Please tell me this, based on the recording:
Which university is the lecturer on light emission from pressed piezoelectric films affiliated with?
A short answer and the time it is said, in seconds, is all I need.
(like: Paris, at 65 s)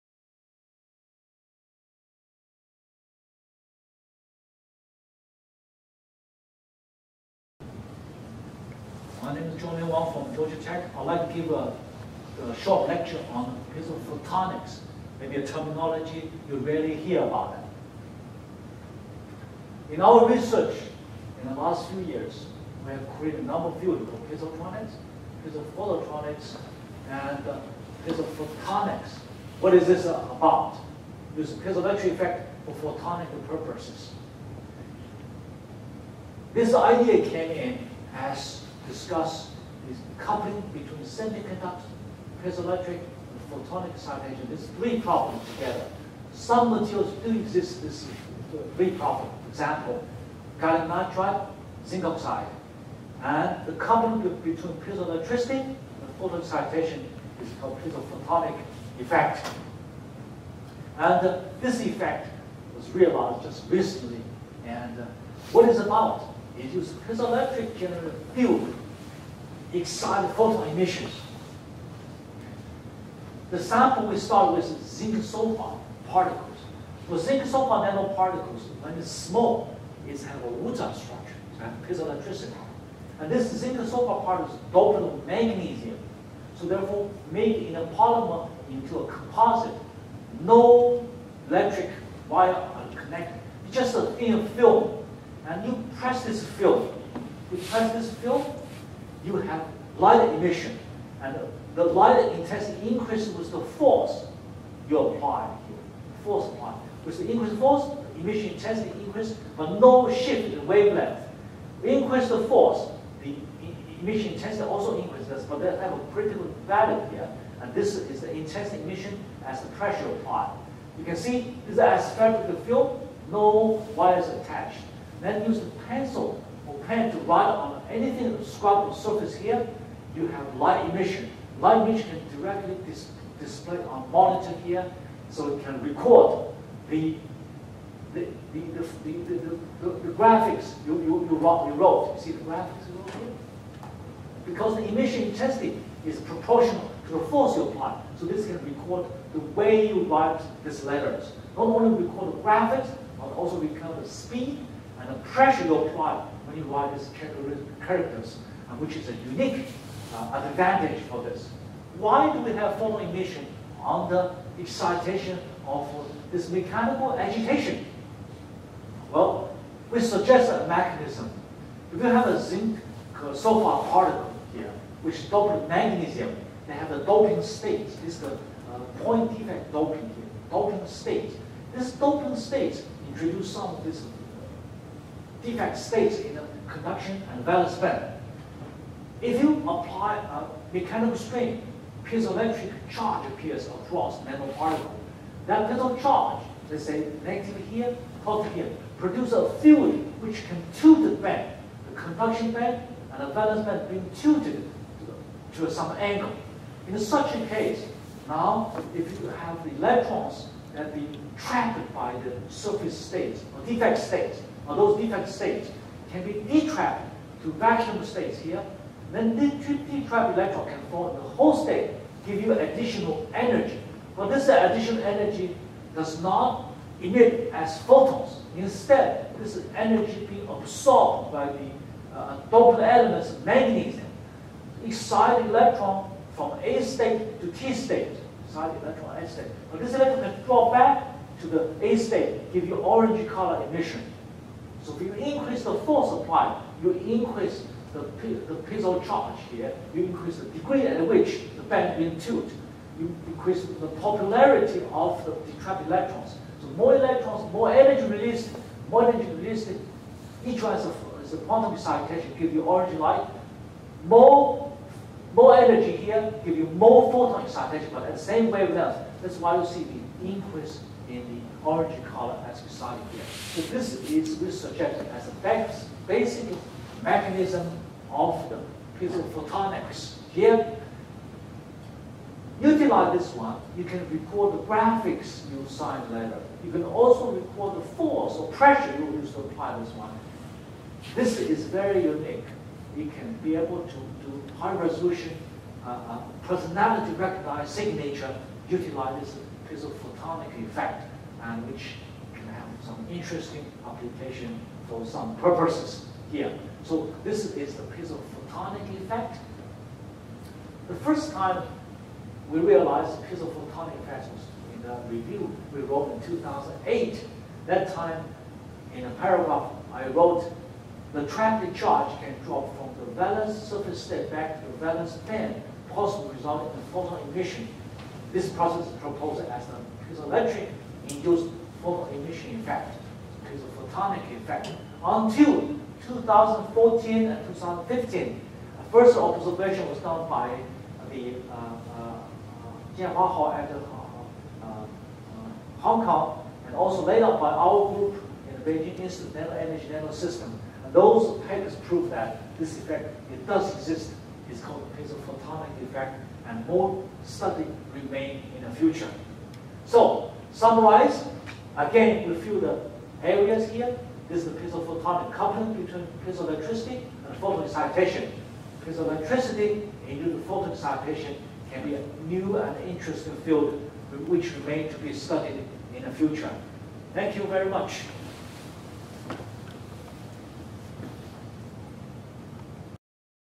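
Georgia Tech, at 10 s.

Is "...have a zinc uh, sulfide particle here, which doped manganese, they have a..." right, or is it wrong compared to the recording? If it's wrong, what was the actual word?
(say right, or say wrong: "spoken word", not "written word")
right.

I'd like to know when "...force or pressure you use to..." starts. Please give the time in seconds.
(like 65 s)
287 s.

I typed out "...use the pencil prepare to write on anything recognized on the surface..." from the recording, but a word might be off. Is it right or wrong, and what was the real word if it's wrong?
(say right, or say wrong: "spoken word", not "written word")
wrong: "described", not "recognized".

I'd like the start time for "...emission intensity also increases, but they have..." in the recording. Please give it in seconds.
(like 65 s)
114 s.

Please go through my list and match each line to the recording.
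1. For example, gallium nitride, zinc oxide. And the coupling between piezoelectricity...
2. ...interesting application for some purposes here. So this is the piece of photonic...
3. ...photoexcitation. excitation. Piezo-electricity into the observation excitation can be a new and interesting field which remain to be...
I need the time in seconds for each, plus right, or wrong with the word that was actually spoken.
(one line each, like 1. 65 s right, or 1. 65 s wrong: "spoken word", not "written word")
1. 49 s right
2. 303 s right
3. 367 s wrong: "photon", not "observation".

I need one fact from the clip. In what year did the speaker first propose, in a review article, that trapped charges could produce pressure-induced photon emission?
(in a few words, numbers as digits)
2008.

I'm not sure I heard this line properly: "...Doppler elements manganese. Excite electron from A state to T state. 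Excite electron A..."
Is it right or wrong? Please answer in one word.
right.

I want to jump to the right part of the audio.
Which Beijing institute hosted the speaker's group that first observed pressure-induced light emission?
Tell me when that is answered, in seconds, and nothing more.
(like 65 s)
348 s.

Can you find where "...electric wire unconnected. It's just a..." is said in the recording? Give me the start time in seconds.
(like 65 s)
91 s.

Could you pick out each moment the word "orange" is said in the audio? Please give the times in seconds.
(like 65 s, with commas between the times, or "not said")
242 s, 262 s, 271 s.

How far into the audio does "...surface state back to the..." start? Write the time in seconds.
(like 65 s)
323 s.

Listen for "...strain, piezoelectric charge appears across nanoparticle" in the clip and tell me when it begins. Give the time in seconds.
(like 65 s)
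191 s.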